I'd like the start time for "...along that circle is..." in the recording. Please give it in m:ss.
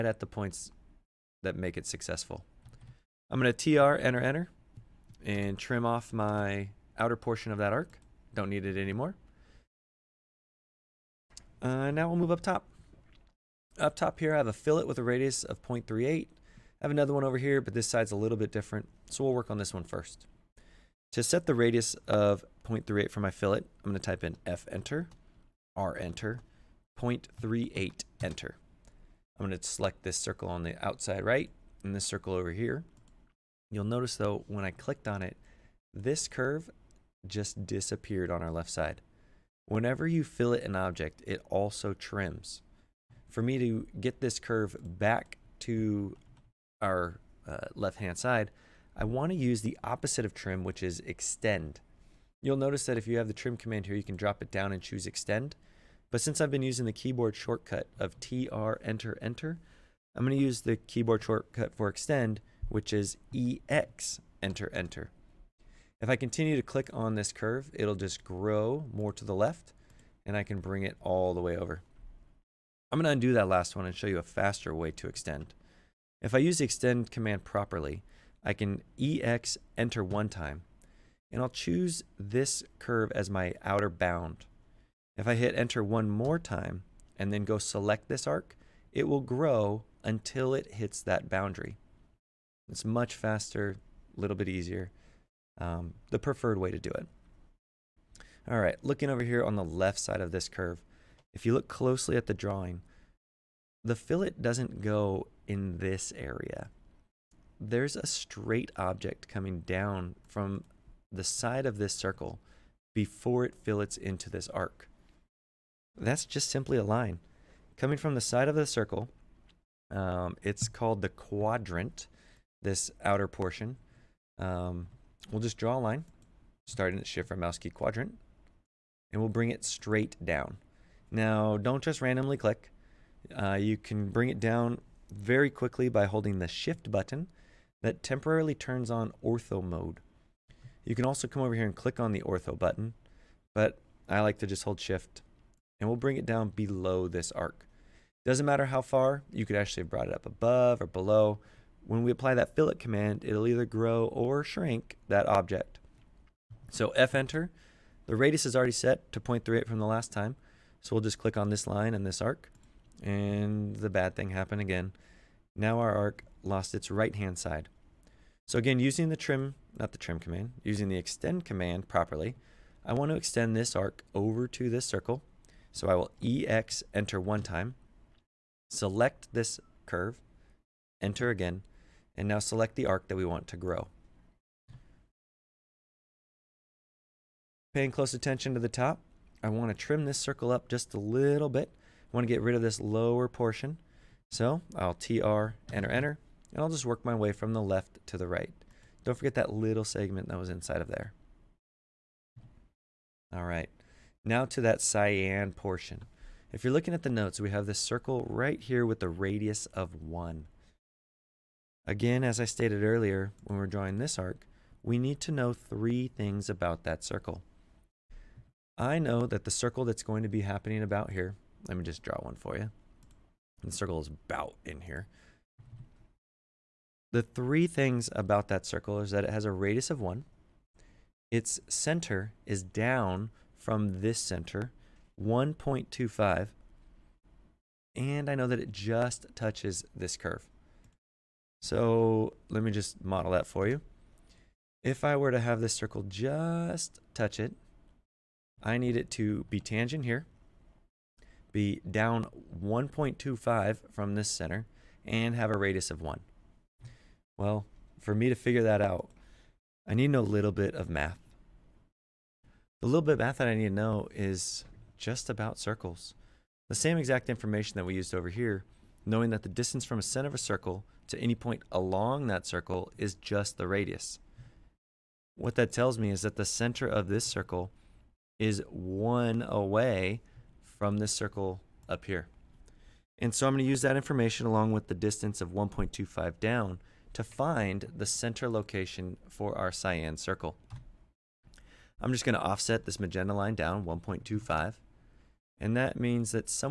4:31.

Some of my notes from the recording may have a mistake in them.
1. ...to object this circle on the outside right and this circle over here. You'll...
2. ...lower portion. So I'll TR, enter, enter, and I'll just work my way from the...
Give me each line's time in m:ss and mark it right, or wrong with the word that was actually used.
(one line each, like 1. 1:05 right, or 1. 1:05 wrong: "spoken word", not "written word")
1. 0:29 wrong: "select", not "object"
2. 3:12 right.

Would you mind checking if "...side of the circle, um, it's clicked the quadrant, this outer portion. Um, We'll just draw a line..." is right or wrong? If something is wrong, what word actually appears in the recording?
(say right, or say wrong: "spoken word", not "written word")
wrong: "called", not "clicked".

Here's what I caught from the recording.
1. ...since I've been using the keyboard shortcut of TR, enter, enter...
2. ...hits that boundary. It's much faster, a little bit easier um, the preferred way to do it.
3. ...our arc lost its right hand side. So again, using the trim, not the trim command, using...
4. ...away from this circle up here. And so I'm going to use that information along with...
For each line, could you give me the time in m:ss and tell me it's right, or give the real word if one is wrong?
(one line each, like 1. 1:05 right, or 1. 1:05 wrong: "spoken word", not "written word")
1. 0:56 right
2. 1:30 right
3. 2:45 right
4. 4:39 right.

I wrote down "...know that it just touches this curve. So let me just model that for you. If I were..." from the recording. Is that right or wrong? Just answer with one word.
right.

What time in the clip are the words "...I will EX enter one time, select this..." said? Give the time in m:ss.
2:55.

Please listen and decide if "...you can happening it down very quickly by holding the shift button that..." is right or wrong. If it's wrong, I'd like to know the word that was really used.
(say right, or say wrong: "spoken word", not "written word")
wrong: "bring", not "happening".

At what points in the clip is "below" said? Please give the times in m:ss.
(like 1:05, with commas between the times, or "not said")
2:26, 2:30.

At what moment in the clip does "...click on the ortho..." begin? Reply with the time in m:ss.
2:21.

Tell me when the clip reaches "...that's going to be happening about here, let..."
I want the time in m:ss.
3:39.